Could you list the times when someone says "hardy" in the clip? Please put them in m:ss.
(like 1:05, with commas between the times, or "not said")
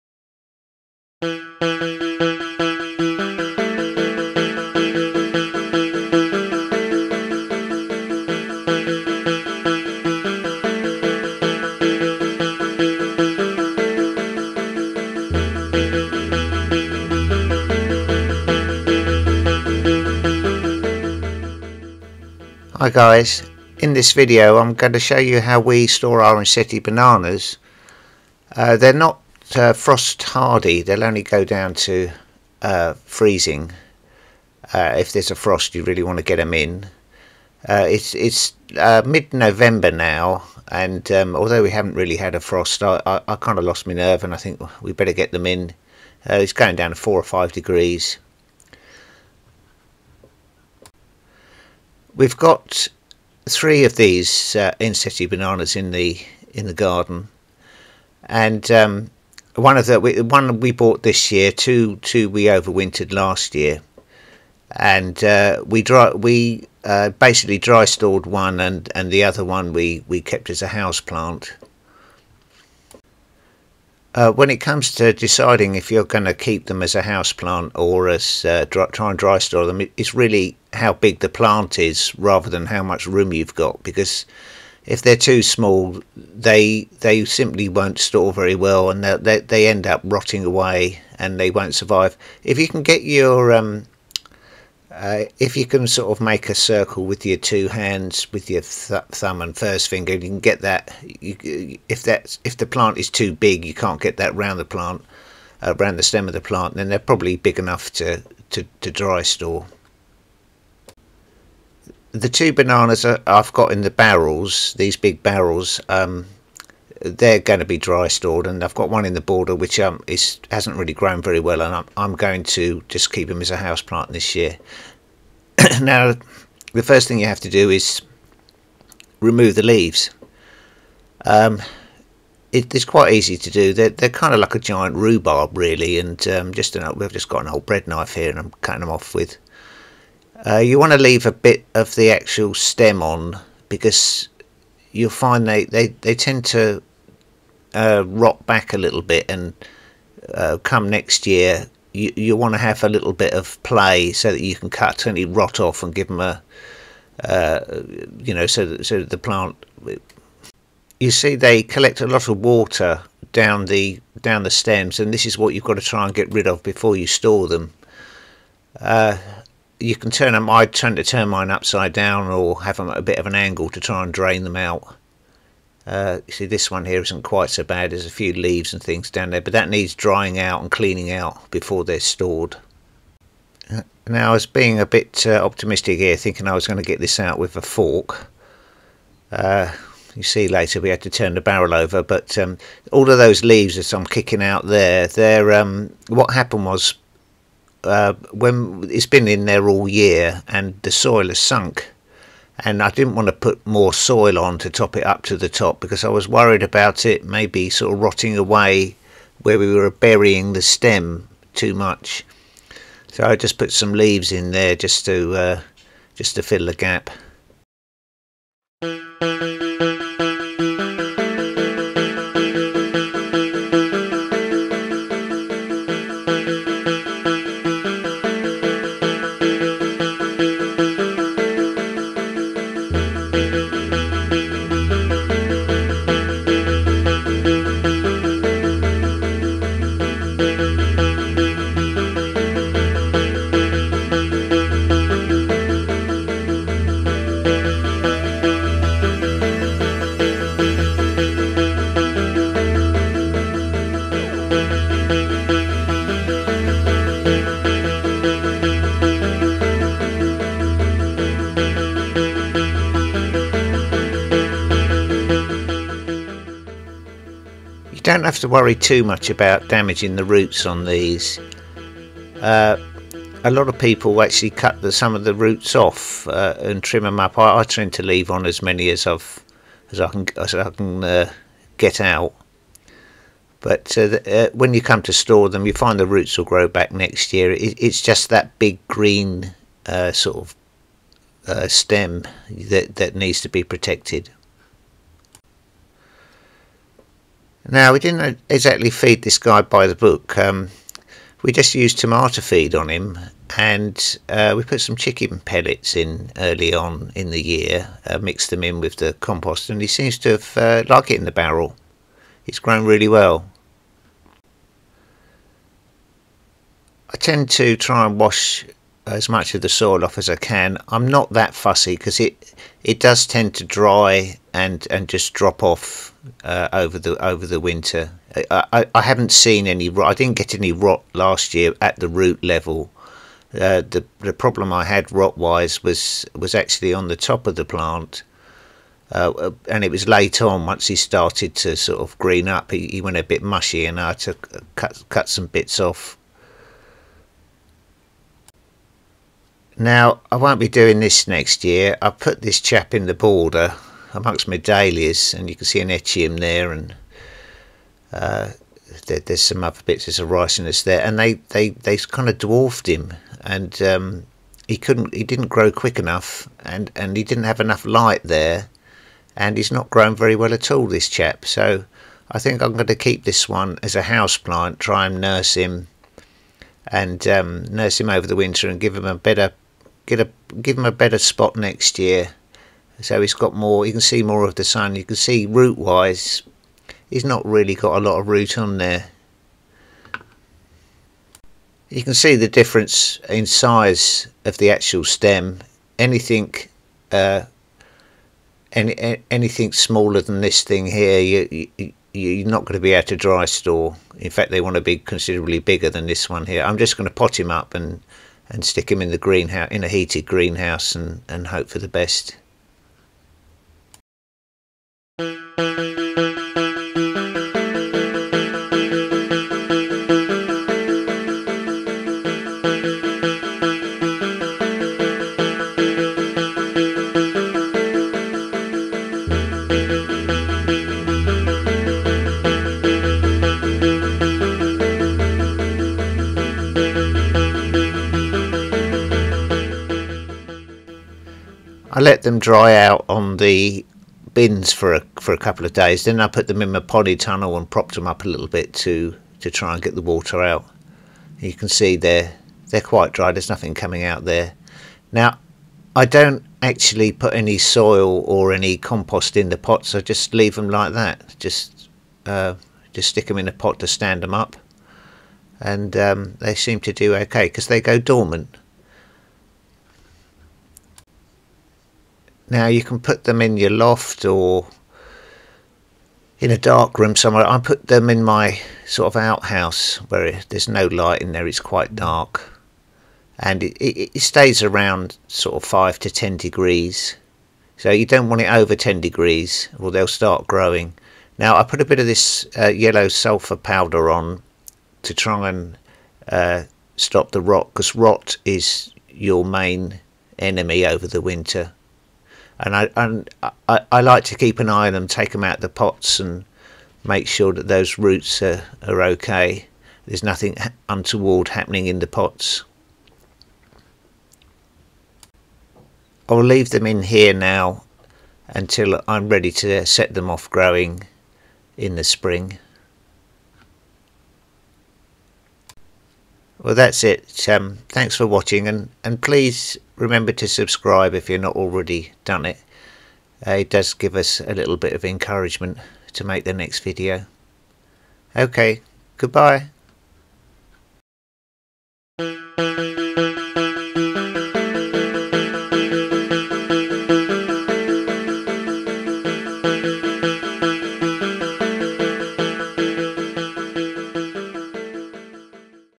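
0:30.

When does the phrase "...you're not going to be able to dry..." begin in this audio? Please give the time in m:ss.
6:42.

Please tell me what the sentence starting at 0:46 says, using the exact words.
Uh, it's going down to four or five degrees.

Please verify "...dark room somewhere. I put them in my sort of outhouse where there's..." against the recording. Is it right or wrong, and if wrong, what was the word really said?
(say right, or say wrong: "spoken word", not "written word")
right.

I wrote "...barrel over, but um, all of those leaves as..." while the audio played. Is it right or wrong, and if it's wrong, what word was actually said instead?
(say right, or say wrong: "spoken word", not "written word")
right.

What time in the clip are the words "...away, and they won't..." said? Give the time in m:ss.
1:30.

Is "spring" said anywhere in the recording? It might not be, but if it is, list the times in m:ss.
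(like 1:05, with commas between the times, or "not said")
8:42.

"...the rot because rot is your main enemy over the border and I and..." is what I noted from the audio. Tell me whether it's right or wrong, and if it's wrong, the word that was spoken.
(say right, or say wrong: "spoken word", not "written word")
wrong: "winter", not "border".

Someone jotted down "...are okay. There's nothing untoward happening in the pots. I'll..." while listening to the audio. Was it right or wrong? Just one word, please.
right.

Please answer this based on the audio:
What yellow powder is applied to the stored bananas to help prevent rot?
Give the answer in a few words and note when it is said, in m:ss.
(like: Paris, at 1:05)
Sulfur powder, at 8:12.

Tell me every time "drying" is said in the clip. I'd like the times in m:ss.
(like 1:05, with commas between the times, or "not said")
2:59.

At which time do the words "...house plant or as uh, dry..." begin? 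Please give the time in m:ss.
1:17.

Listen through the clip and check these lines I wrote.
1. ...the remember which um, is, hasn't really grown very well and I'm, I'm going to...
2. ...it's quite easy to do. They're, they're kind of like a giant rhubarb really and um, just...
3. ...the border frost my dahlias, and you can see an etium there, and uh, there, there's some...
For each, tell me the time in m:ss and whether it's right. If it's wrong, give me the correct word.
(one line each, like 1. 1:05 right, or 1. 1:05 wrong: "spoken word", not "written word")
1. 1:59 wrong: "border", not "remember"
2. 2:12 right
3. 5:53 wrong: "amongst", not "frost".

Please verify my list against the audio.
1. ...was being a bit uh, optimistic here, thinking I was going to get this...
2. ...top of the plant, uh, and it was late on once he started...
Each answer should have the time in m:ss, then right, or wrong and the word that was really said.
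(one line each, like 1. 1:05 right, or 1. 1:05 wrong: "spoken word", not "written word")
1. 3:04 right
2. 5:37 right.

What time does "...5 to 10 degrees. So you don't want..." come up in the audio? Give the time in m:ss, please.
8:05.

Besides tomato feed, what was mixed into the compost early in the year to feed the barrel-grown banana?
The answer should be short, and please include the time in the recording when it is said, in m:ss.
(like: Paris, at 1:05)
Chicken pellets, at 5:04.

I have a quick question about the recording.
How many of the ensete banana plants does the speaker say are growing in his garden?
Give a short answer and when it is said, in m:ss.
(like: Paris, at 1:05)
3, at 0:53.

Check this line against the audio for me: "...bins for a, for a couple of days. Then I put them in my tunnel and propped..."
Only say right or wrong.
right.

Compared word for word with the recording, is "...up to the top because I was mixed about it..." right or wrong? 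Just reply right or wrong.
wrong.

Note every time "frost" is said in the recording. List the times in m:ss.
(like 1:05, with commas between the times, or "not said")
0:29, 0:35, 0:42.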